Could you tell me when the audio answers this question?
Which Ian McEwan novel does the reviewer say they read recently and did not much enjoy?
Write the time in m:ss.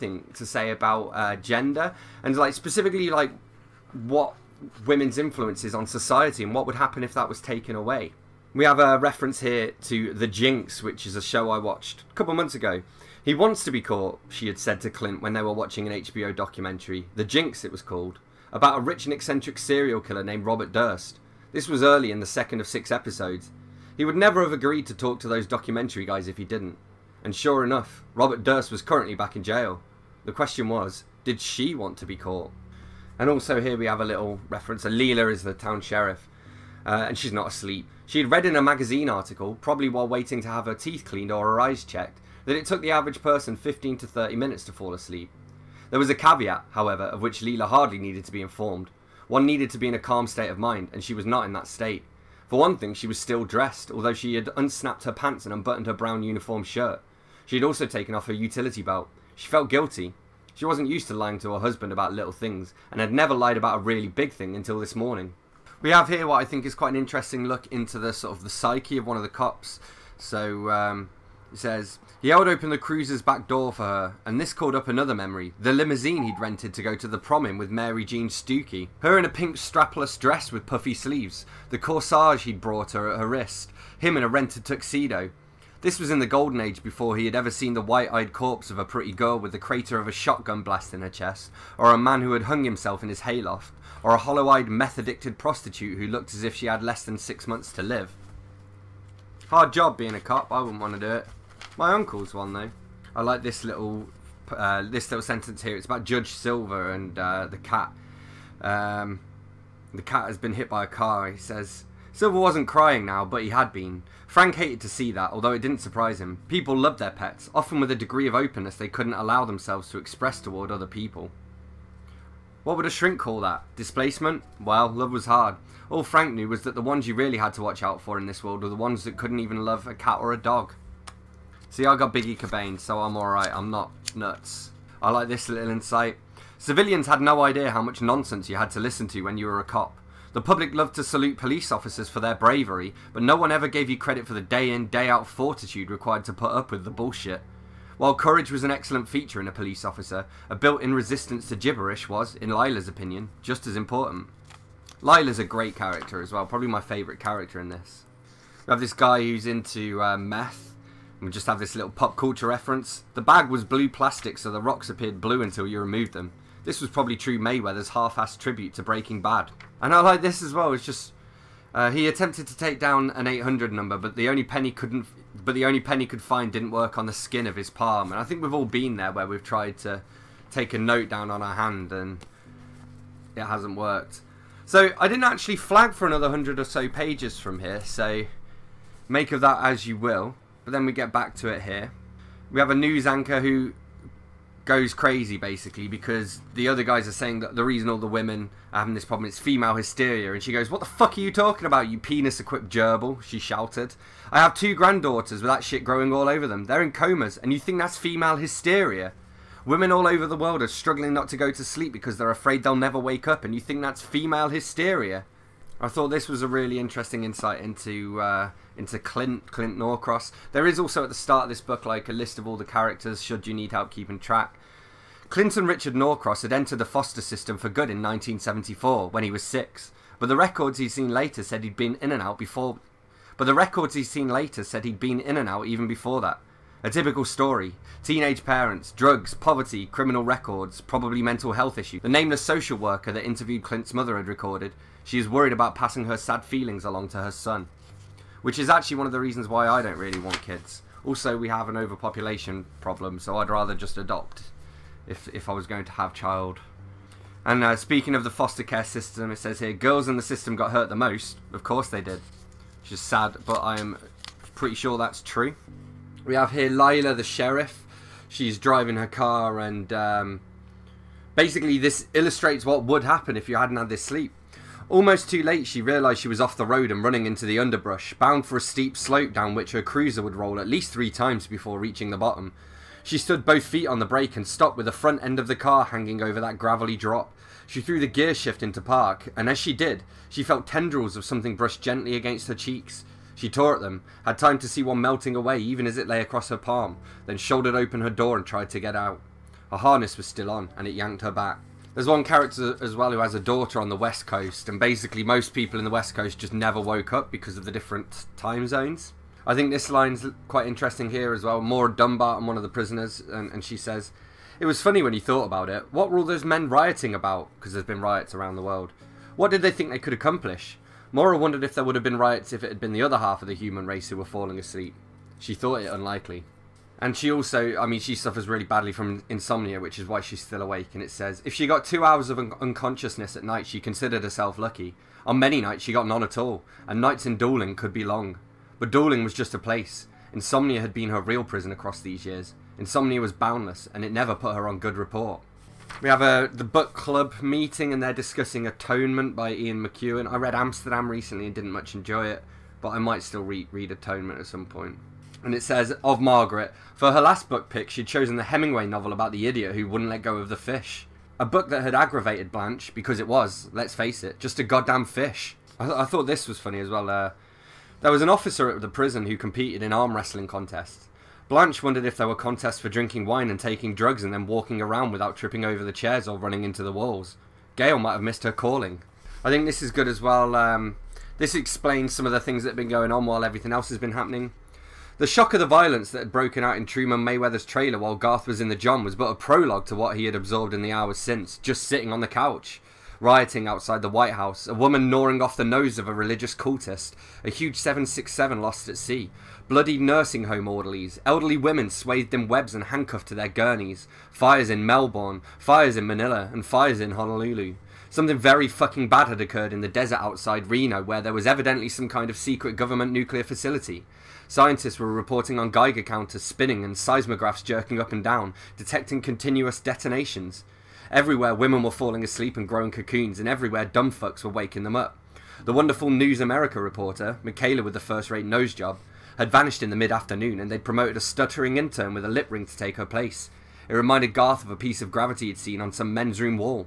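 5:50.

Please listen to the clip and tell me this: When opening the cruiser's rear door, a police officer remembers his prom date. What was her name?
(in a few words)
Mary Jean Stukey.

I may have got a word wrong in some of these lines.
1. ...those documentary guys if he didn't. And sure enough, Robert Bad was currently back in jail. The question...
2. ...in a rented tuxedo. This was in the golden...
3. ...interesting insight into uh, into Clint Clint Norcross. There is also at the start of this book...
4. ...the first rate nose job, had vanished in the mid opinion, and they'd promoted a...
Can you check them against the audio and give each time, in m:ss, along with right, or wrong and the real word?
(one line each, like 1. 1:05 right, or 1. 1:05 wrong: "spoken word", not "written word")
1. 0:25 wrong: "Durst", not "Bad"
2. 1:24 right
3. 3:36 right
4. 7:07 wrong: "afternoon", not "opinion".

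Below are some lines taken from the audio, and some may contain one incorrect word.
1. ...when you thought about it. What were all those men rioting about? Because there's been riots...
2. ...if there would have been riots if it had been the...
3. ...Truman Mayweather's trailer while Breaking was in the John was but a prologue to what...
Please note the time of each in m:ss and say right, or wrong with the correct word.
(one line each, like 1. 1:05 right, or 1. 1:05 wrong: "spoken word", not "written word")
1. 5:15 right
2. 5:21 right
3. 6:26 wrong: "Garth", not "Breaking".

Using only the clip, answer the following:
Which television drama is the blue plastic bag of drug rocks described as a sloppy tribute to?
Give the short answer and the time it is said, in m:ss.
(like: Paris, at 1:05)
Breaking Bad, at 2:48.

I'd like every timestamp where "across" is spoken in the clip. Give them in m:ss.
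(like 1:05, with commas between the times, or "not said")
4:56, 5:41.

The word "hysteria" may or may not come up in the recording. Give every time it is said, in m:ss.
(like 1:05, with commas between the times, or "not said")
3:19, 3:28, 3:34.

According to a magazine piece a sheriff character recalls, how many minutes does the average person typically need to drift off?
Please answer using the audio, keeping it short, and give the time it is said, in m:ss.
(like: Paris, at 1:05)
15 to 30, at 0:43.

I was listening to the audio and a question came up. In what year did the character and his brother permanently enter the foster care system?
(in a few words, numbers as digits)
1974.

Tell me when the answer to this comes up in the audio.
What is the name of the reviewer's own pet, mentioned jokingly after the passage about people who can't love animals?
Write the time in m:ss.
2:12.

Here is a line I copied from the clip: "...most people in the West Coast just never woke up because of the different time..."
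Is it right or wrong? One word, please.
right.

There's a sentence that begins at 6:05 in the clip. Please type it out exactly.
I, th- I thought this was funny as well.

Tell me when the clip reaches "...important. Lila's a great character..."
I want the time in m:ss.
2:33.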